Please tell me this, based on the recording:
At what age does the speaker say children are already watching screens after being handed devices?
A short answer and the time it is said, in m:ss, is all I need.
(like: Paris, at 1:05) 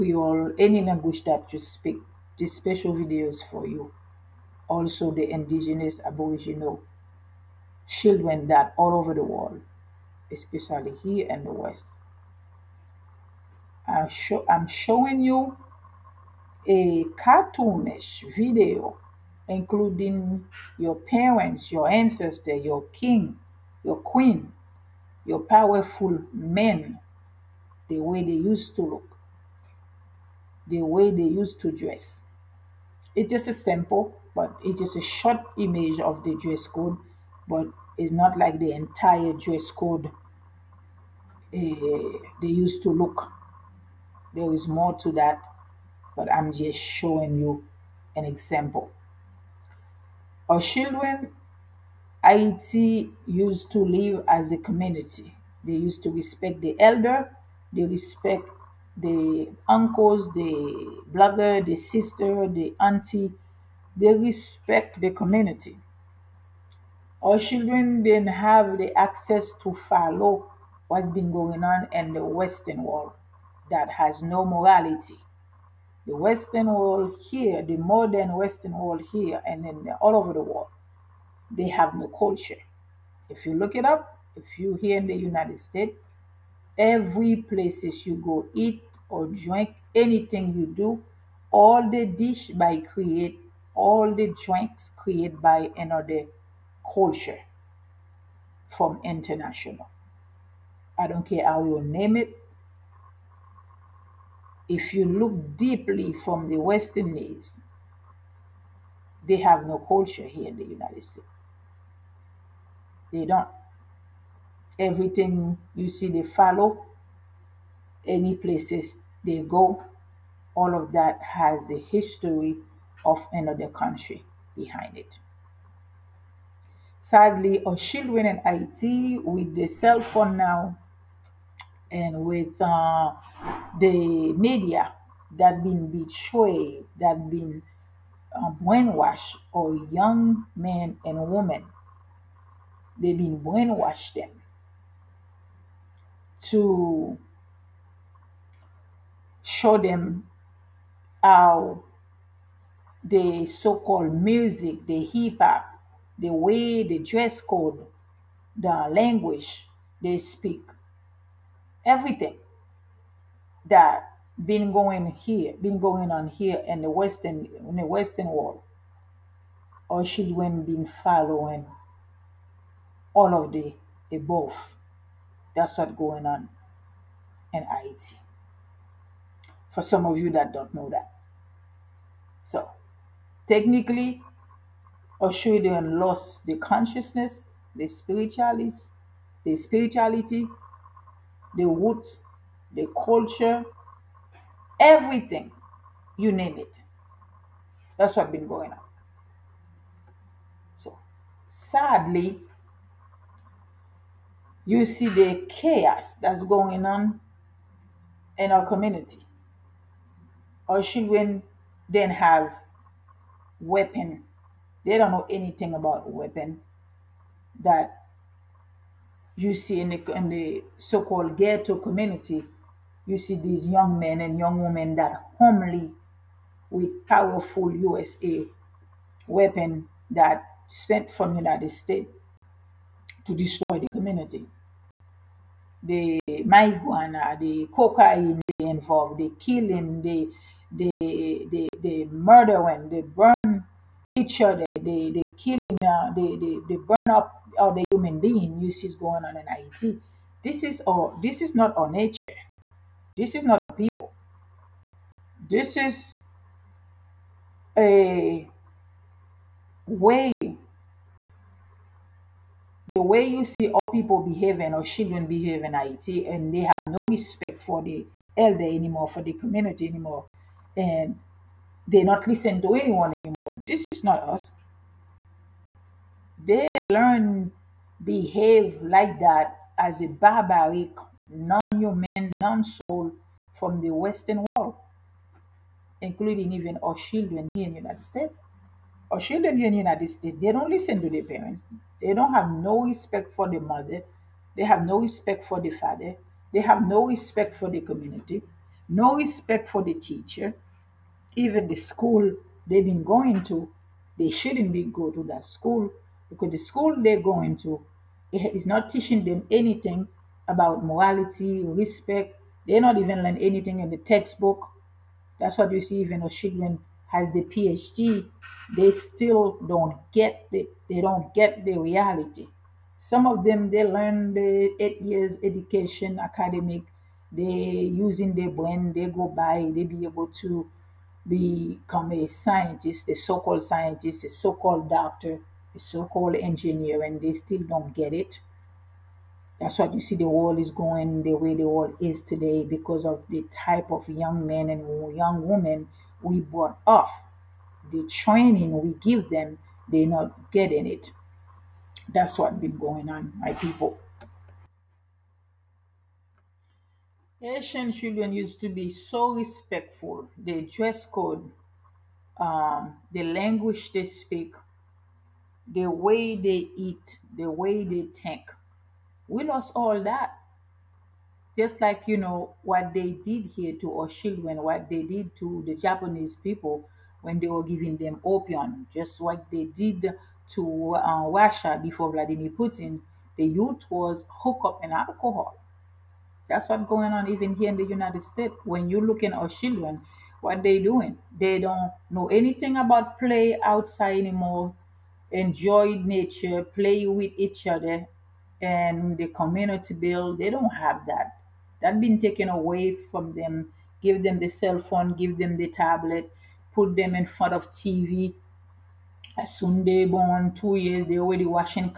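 2 years, at 6:50.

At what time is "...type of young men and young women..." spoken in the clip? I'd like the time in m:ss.
5:43.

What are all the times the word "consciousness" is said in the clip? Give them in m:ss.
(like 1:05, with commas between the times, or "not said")
3:06.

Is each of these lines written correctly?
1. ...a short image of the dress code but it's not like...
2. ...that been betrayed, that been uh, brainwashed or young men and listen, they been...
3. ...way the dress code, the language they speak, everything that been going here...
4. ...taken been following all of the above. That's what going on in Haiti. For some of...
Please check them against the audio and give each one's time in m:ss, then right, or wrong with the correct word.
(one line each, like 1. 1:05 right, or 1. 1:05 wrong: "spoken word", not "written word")
1. 0:34 right
2. 2:15 wrong: "women", not "listen"
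3. 2:36 right
4. 2:50 wrong: "children", not "taken".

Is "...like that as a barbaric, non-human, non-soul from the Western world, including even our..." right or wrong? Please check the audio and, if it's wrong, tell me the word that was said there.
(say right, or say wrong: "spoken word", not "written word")
right.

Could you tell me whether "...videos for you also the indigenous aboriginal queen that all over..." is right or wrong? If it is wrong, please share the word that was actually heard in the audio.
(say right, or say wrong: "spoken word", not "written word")
wrong: "children", not "queen".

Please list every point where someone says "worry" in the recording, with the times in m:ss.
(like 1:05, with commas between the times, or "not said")
not said.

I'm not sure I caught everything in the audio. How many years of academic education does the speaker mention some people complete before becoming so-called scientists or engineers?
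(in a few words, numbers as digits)
8 years.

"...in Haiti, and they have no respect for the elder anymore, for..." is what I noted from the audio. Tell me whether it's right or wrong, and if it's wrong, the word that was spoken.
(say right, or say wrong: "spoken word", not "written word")
right.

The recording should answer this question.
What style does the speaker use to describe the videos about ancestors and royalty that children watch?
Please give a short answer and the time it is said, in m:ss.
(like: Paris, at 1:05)
cartoonish, at 0:17.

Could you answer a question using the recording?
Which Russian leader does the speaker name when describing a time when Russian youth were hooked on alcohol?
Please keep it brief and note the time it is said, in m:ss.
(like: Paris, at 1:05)
Vladimir Putin, at 6:22.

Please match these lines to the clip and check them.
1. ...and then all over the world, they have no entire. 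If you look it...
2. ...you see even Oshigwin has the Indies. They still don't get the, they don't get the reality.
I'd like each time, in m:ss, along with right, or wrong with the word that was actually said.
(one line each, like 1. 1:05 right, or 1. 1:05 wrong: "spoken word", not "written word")
1. 1:19 wrong: "culture", not "entire"
2. 5:15 wrong: "PhD", not "Indies".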